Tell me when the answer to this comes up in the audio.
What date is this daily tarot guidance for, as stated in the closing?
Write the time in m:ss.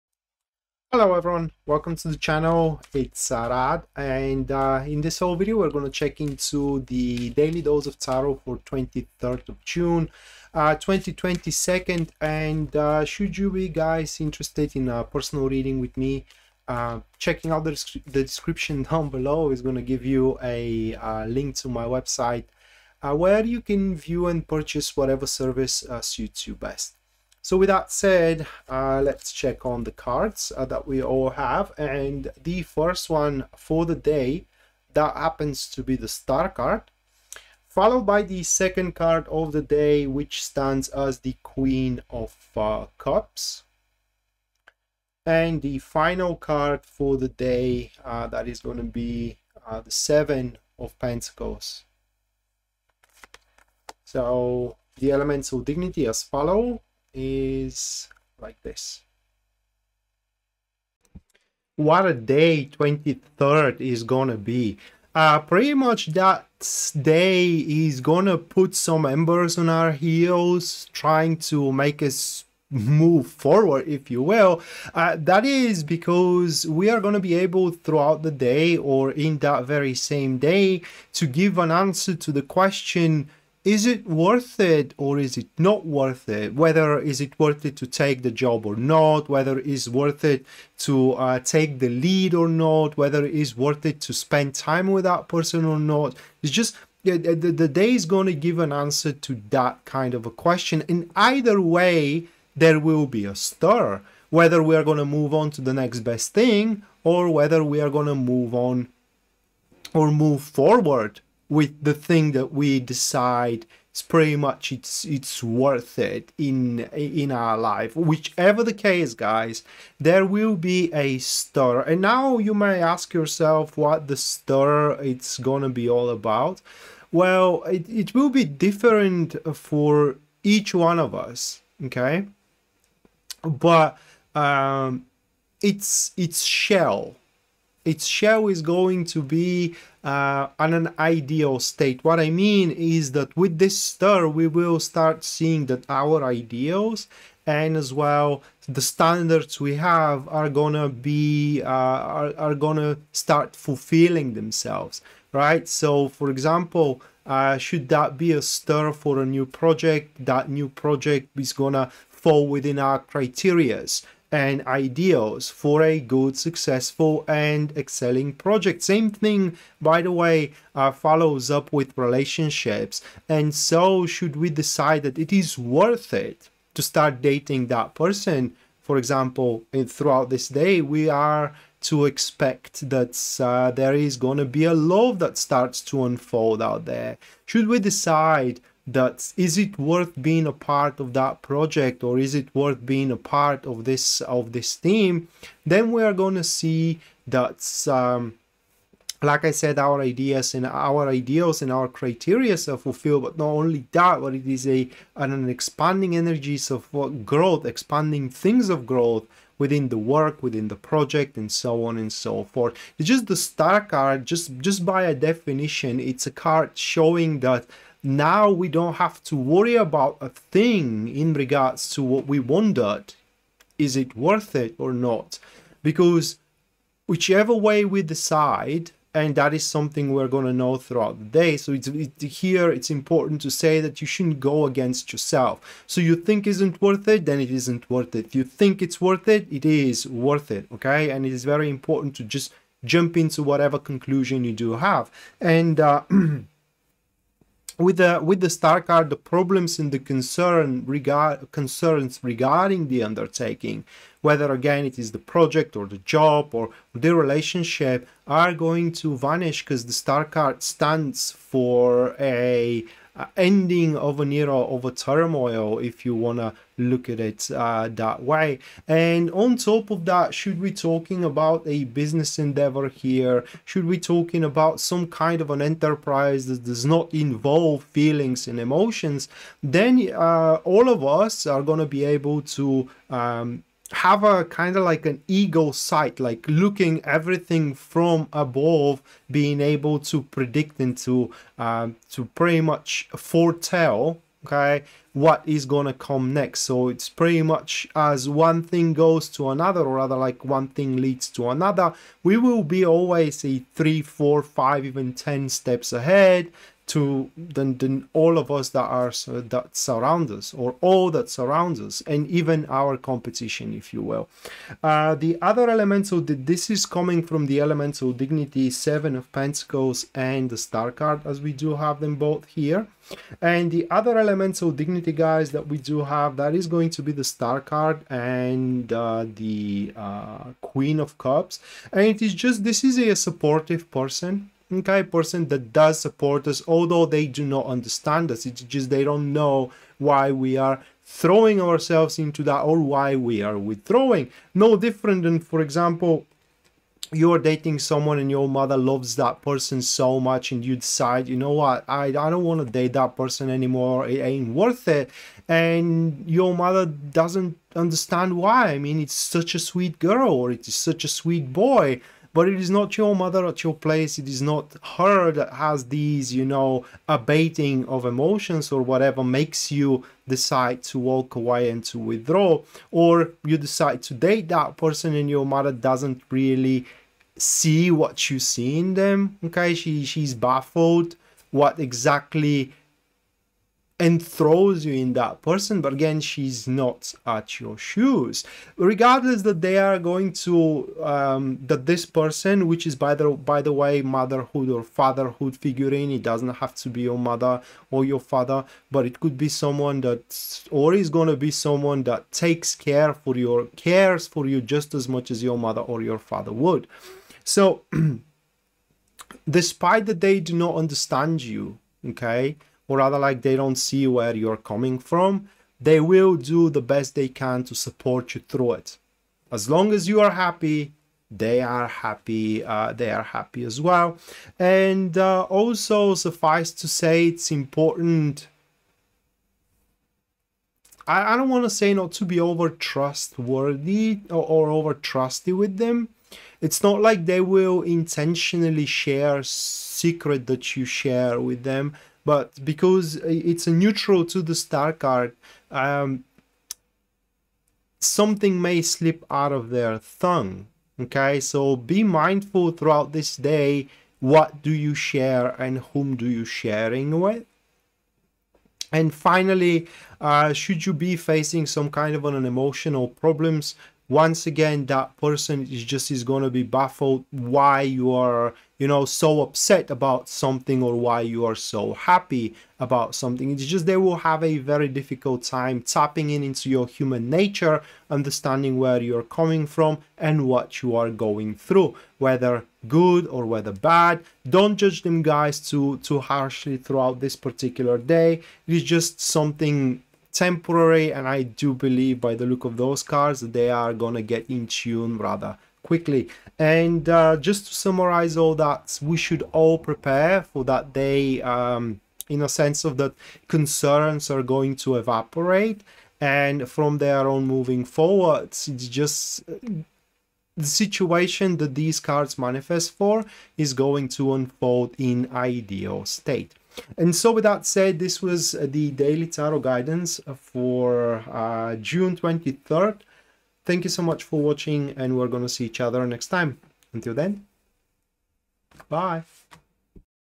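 8:41.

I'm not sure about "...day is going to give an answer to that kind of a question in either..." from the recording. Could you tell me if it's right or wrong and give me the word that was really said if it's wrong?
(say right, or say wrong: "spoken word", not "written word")
right.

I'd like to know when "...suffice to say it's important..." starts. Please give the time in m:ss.
7:06.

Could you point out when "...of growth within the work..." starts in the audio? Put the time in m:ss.
3:28.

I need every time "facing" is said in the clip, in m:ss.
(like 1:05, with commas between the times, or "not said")
7:41.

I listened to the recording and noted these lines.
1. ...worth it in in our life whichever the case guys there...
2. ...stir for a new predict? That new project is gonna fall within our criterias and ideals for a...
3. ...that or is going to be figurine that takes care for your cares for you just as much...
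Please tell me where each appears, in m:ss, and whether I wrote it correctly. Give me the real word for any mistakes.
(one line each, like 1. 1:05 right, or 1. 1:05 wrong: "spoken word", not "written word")
1. 1:55 right
2. 2:38 wrong: "project", not "predict"
3. 6:40 wrong: "someone", not "figurine".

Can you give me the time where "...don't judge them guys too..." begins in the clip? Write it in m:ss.
8:04.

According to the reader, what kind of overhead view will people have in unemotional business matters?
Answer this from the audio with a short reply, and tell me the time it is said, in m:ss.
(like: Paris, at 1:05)
ego sight, at 4:45.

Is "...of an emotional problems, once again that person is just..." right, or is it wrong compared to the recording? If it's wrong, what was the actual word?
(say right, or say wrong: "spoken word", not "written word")
right.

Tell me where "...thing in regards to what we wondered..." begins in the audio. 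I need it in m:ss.
3:40.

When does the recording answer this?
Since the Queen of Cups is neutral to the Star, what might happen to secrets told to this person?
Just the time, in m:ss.
7:27.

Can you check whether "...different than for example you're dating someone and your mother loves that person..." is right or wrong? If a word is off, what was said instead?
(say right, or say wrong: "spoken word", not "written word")
right.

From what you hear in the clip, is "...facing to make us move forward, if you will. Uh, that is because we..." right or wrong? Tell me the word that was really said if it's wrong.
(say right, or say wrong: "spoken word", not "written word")
wrong: "trying", not "facing".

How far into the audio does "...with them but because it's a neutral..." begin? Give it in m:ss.
7:21.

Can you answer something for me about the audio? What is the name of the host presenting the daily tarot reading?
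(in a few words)
Arad Rad.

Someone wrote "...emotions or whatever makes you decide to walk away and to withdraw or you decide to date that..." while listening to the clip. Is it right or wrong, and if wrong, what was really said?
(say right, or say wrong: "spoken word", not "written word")
right.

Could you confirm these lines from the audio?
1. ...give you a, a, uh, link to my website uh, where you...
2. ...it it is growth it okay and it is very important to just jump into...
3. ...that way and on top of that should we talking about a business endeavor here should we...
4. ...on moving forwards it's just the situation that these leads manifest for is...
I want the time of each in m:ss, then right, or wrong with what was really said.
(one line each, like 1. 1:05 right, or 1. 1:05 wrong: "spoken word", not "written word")
1. 0:19 right
2. 3:59 wrong: "worth", not "growth"
3. 4:27 right
4. 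8:27 wrong: "cards", not "leads".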